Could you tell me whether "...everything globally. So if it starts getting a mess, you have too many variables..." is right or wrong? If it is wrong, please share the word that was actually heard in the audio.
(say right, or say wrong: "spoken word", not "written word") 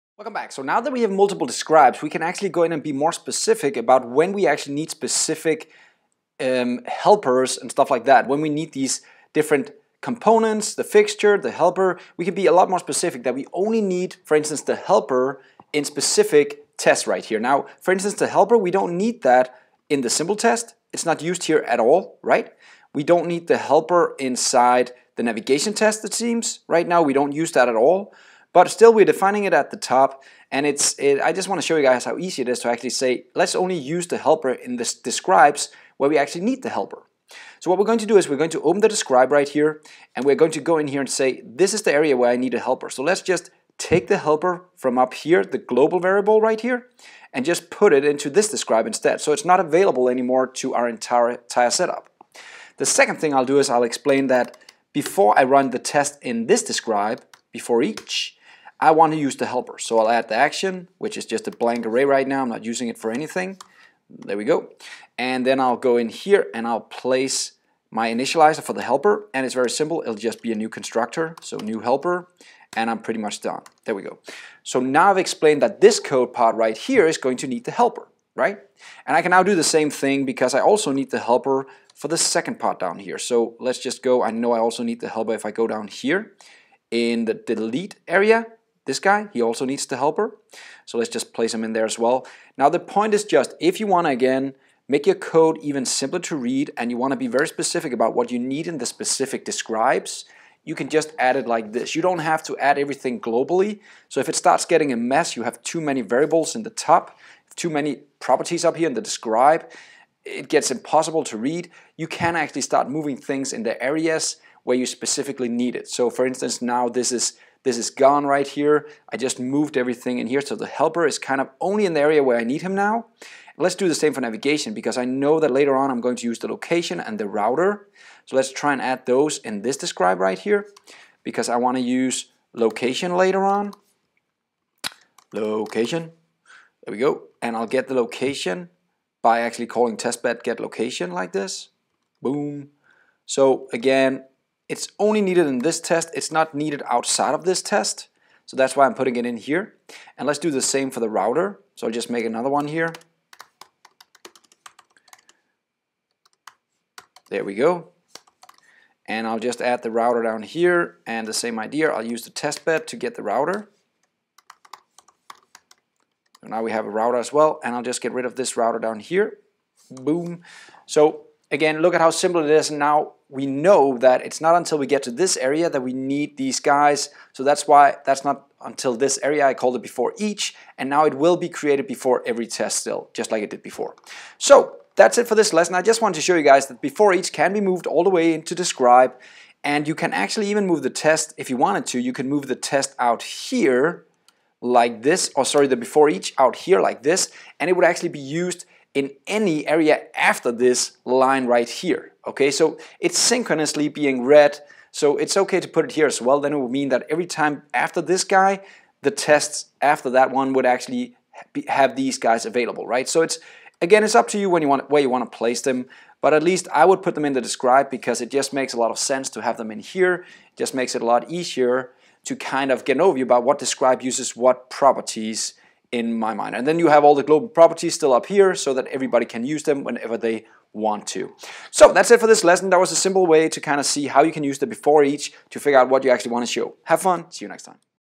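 right.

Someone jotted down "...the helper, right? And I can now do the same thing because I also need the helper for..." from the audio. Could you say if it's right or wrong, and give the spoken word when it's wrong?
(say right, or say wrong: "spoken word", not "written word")
right.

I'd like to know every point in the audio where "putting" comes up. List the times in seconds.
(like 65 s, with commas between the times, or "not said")
148 s.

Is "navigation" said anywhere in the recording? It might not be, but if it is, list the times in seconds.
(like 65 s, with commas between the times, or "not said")
25 s, 124 s.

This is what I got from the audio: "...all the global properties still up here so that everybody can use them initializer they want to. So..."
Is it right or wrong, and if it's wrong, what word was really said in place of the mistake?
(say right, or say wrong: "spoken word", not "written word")
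wrong: "whenever", not "initializer".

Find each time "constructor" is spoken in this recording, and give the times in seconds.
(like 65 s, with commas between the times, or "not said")
70 s.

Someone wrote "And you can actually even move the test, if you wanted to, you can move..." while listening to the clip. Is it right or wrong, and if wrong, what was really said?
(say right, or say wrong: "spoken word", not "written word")
right.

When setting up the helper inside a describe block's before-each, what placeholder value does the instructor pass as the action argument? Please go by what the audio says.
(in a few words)
a blank array.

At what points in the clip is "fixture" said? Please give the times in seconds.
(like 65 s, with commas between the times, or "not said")
10 s.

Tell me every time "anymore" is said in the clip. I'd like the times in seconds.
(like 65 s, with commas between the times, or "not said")
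50 s.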